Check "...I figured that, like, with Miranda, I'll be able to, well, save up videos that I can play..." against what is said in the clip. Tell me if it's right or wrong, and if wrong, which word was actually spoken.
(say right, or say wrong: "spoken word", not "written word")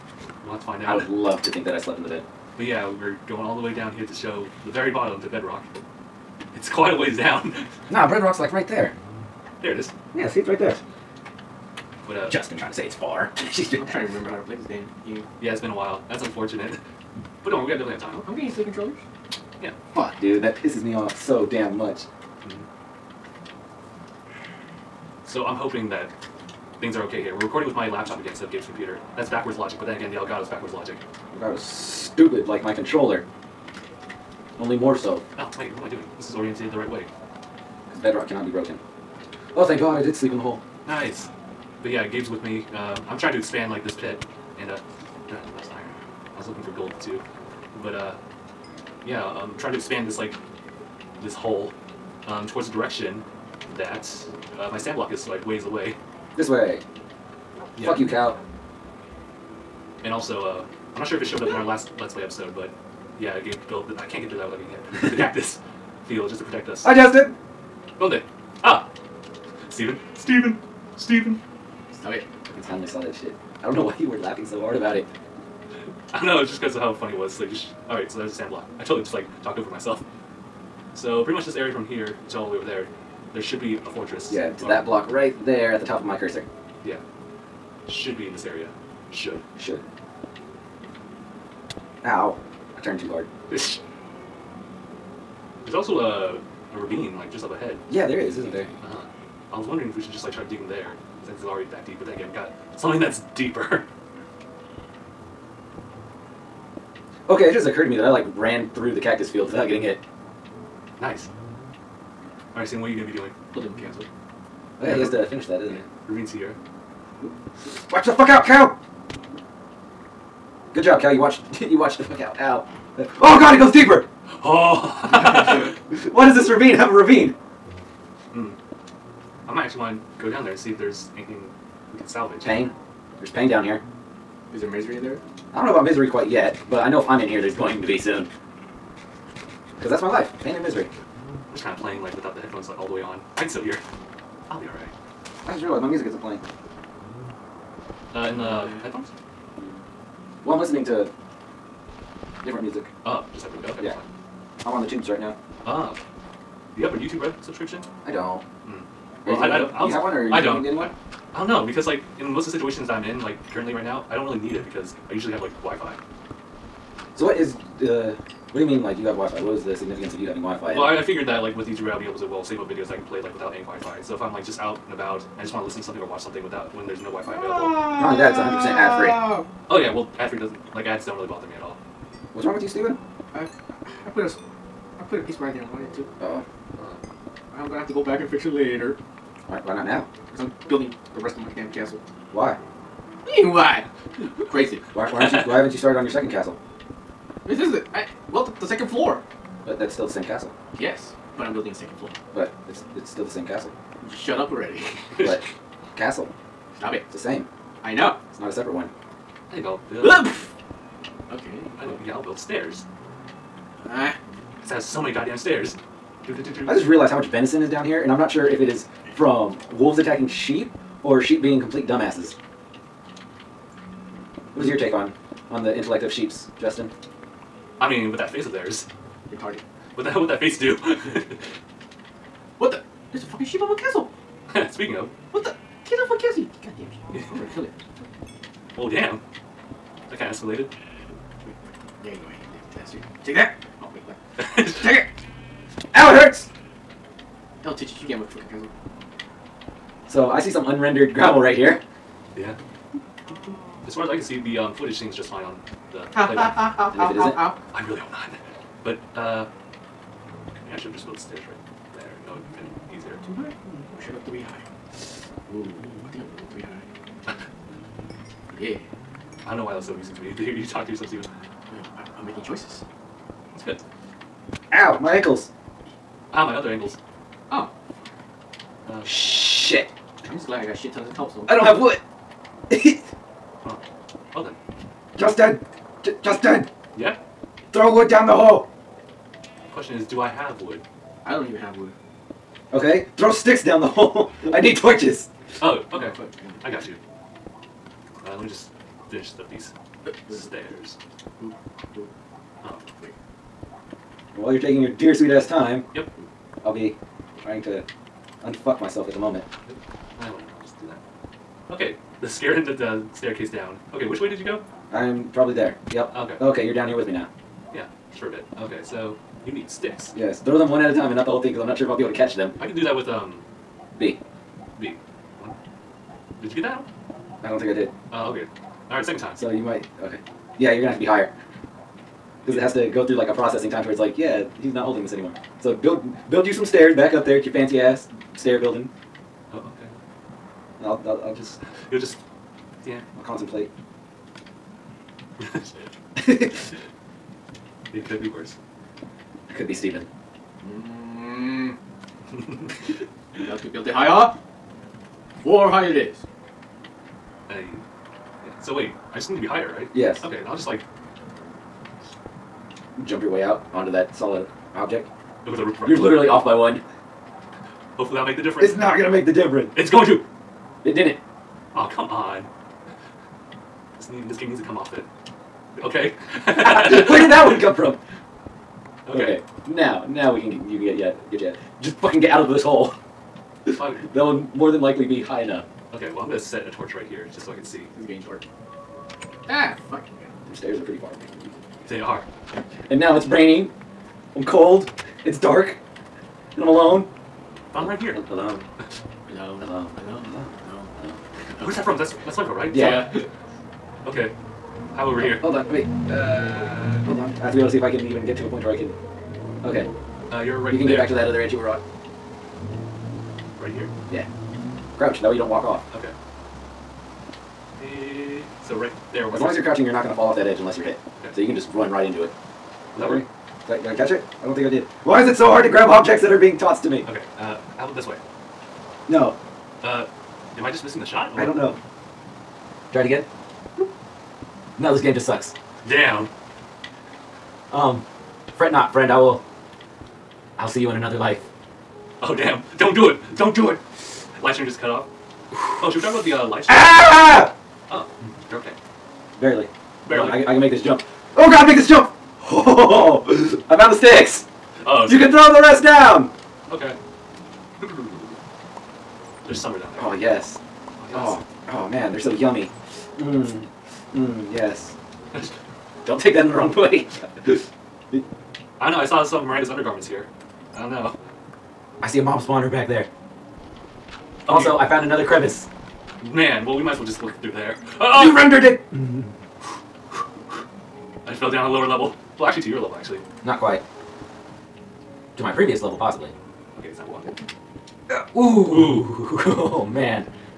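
wrong: "YouTube", not "Miranda".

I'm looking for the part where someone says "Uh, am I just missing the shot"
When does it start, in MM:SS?
07:09.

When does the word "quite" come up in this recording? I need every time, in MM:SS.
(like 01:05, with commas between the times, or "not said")
00:06, 02:16, 08:03.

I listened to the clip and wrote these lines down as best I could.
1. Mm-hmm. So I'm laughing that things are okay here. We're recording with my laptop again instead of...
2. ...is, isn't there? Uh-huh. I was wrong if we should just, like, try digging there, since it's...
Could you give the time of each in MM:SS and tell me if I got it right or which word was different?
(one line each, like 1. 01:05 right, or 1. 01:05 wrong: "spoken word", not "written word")
1. 00:22 wrong: "hoping", not "laughing"
2. 01:38 wrong: "wondering", not "wrong".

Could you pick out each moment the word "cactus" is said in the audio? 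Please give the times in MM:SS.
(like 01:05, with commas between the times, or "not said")
01:05, 01:48.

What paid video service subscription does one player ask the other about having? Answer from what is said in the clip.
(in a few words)
YouTube Red.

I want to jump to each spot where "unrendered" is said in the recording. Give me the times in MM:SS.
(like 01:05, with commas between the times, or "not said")
04:10.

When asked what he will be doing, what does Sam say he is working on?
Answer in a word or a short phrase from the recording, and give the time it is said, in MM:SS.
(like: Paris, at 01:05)
Building castle, at 01:53.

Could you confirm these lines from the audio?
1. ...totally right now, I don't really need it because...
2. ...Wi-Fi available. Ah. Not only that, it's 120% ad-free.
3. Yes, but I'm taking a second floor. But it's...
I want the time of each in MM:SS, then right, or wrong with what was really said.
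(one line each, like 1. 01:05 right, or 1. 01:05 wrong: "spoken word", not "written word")
1. 02:43 wrong: "currently", not "totally"
2. 02:57 wrong: "100", not "120"
3. 03:20 wrong: "building", not "taking".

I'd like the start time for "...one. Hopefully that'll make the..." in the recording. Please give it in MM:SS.
06:06.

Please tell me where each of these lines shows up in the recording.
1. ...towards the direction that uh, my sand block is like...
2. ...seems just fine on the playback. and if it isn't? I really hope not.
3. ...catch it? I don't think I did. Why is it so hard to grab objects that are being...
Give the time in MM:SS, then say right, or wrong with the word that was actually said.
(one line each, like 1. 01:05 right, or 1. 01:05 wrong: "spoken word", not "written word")
1. 00:52 right
2. 04:14 right
3. 07:03 right.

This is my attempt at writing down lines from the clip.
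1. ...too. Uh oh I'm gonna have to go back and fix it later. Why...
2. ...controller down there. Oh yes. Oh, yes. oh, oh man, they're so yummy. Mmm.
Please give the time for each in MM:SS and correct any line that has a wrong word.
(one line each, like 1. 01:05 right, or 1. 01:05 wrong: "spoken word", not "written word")
1. 03:05 right
2. 07:39 wrong: "summer", not "controller".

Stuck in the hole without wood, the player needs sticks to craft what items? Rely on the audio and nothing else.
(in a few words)
torches.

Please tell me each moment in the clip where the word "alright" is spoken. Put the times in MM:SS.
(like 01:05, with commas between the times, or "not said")
01:17, 02:24.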